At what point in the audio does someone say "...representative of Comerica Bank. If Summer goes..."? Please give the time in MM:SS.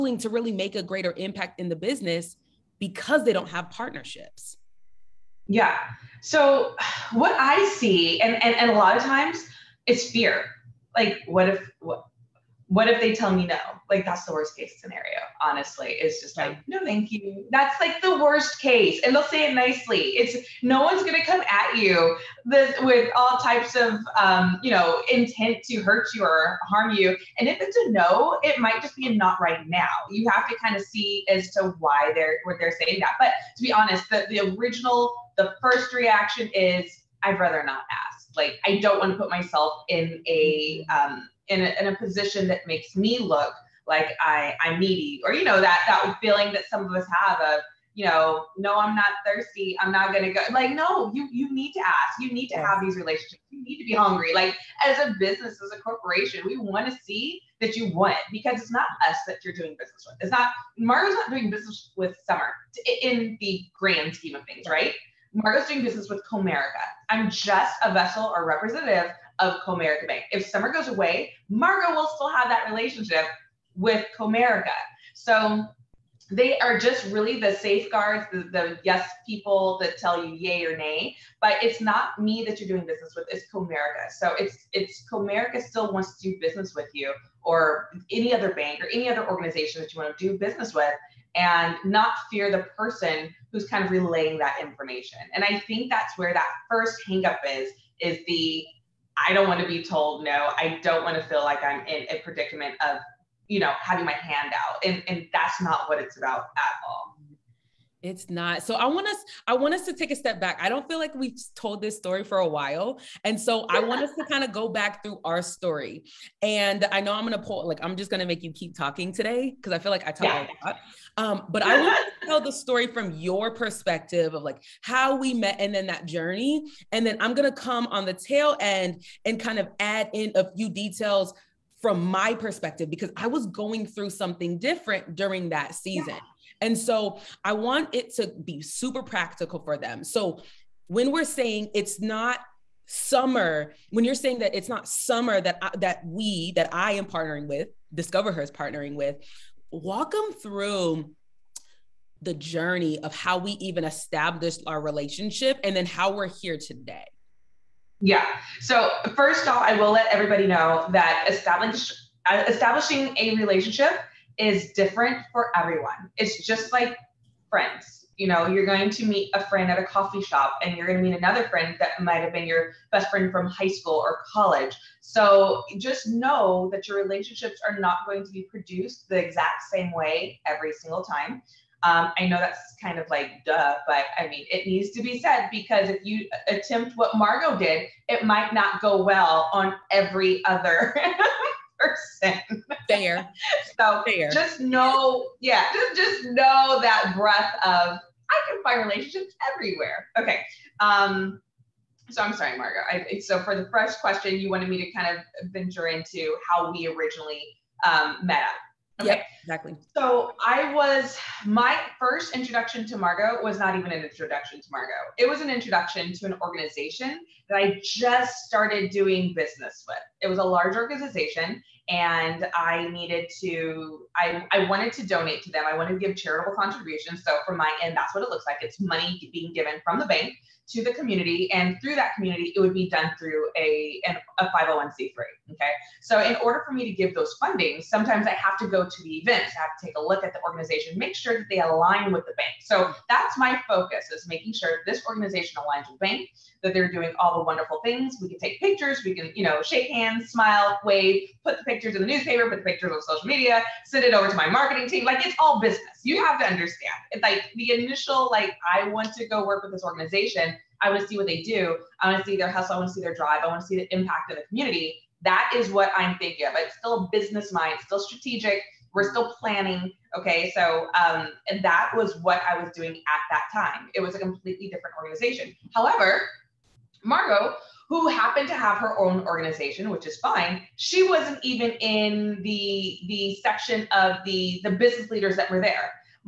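01:08.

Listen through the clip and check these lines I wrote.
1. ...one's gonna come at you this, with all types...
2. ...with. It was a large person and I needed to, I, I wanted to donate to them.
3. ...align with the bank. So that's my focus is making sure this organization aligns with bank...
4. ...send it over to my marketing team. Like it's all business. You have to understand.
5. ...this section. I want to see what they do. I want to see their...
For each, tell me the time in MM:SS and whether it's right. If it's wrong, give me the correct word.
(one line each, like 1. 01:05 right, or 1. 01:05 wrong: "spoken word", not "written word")
1. 00:20 right
2. 03:39 wrong: "organization", not "person"
3. 04:01 right
4. 04:13 right
5. 04:19 wrong: "organization", not "section".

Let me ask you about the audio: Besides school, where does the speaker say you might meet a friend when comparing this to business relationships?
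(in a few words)
coffee shop.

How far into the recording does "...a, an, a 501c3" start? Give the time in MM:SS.
03:53.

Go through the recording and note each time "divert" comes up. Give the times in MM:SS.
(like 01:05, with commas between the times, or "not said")
not said.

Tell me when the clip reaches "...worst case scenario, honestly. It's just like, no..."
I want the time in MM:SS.
00:14.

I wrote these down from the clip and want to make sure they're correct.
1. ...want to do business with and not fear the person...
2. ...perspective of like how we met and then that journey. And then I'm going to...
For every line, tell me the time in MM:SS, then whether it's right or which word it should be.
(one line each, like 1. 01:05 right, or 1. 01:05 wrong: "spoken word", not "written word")
1. 01:30 right
2. 02:03 right.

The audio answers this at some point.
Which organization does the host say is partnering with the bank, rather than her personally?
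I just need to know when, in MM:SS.
02:27.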